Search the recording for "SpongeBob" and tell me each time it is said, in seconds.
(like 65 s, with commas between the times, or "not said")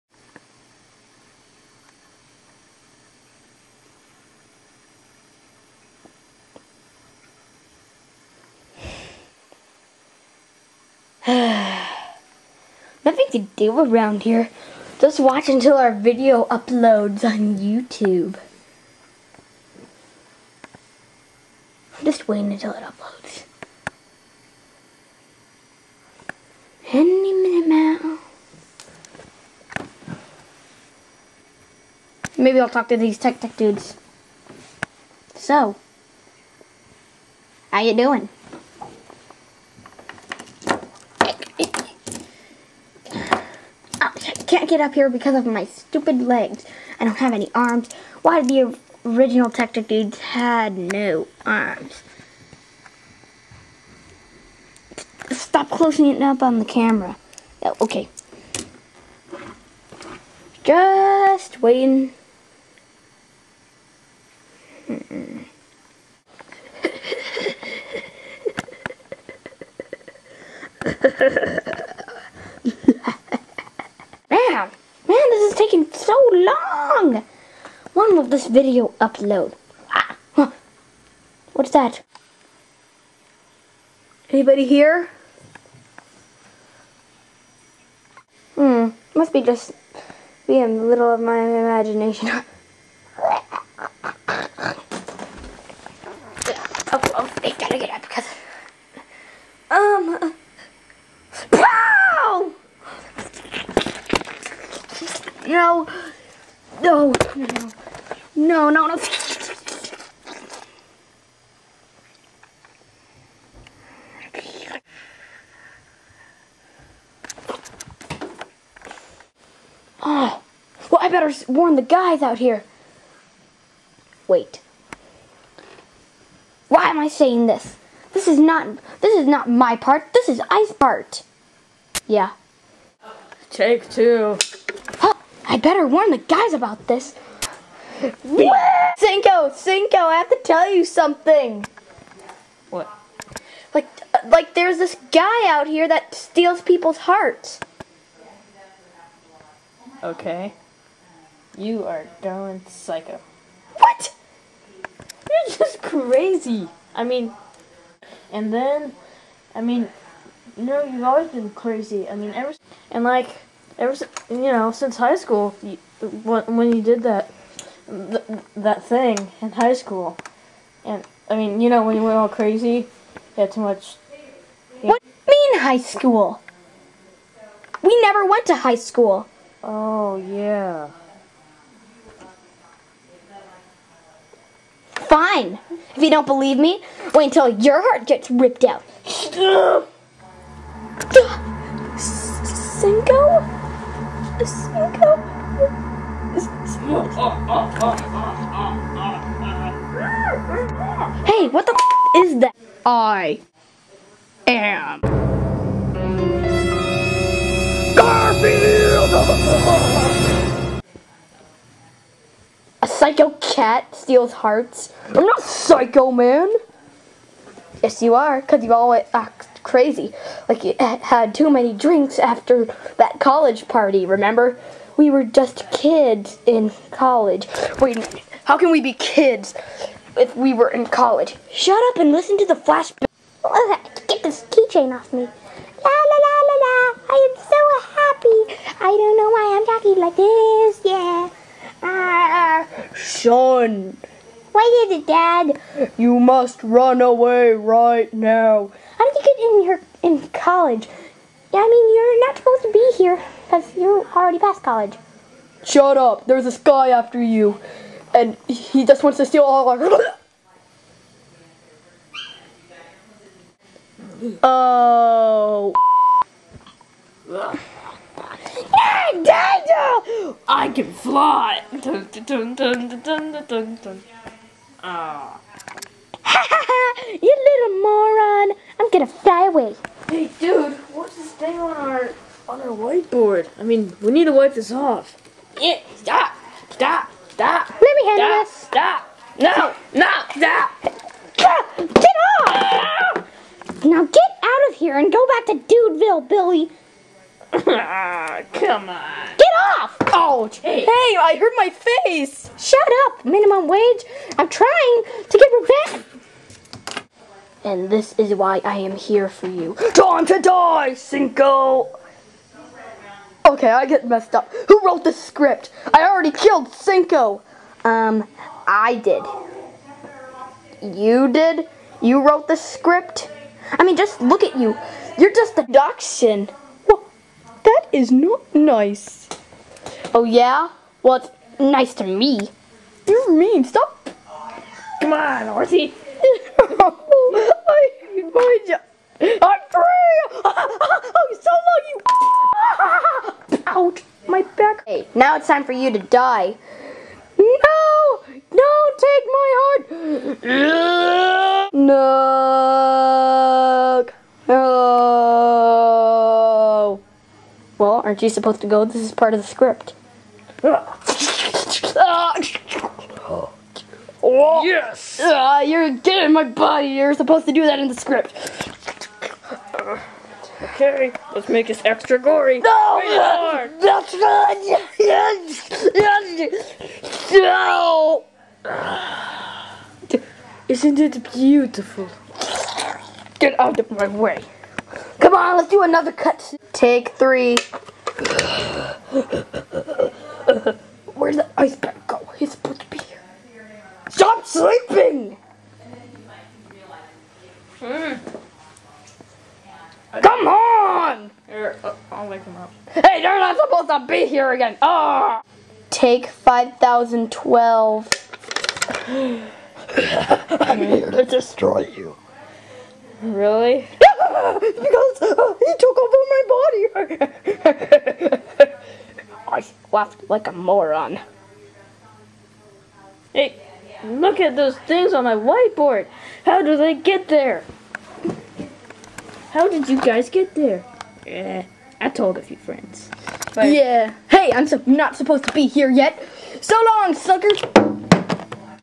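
not said.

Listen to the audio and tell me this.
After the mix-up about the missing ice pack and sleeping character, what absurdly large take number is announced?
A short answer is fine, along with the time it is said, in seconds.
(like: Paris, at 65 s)
5012, at 405 s.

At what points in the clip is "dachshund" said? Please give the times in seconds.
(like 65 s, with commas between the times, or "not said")
325 s.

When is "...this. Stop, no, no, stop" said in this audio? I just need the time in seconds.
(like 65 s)
288 s.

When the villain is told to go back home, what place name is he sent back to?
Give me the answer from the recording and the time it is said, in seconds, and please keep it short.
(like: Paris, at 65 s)
Dudeville, at 295 s.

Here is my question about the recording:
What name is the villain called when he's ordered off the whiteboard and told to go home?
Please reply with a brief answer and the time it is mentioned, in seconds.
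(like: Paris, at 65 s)
Billy, at 296 s.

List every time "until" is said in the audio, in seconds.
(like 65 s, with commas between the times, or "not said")
15 s, 22 s, 187 s.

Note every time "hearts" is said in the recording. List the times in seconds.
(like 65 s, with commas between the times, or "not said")
146 s, 187 s, 214 s, 349 s.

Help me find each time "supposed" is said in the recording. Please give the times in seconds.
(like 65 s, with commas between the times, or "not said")
252 s, 358 s, 367 s, 392 s, 403 s, 435 s.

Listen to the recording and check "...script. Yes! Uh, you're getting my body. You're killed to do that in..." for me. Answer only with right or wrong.
wrong.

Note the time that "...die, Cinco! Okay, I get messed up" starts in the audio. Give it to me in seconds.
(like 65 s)
310 s.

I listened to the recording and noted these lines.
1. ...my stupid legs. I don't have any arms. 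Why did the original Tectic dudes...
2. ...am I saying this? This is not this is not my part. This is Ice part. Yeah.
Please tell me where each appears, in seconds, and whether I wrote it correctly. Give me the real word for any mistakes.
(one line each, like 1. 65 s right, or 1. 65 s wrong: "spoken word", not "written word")
1. 45 s right
2. 126 s right.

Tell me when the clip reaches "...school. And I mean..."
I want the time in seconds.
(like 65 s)
169 s.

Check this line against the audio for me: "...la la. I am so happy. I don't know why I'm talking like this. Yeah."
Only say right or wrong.
right.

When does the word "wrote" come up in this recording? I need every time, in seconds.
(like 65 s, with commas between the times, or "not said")
314 s, 322 s.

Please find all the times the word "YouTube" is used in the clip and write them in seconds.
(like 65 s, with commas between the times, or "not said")
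17 s.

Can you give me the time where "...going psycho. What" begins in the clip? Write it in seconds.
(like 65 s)
152 s.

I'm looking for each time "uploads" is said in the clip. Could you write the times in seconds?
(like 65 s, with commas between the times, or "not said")
16 s, 22 s, 79 s.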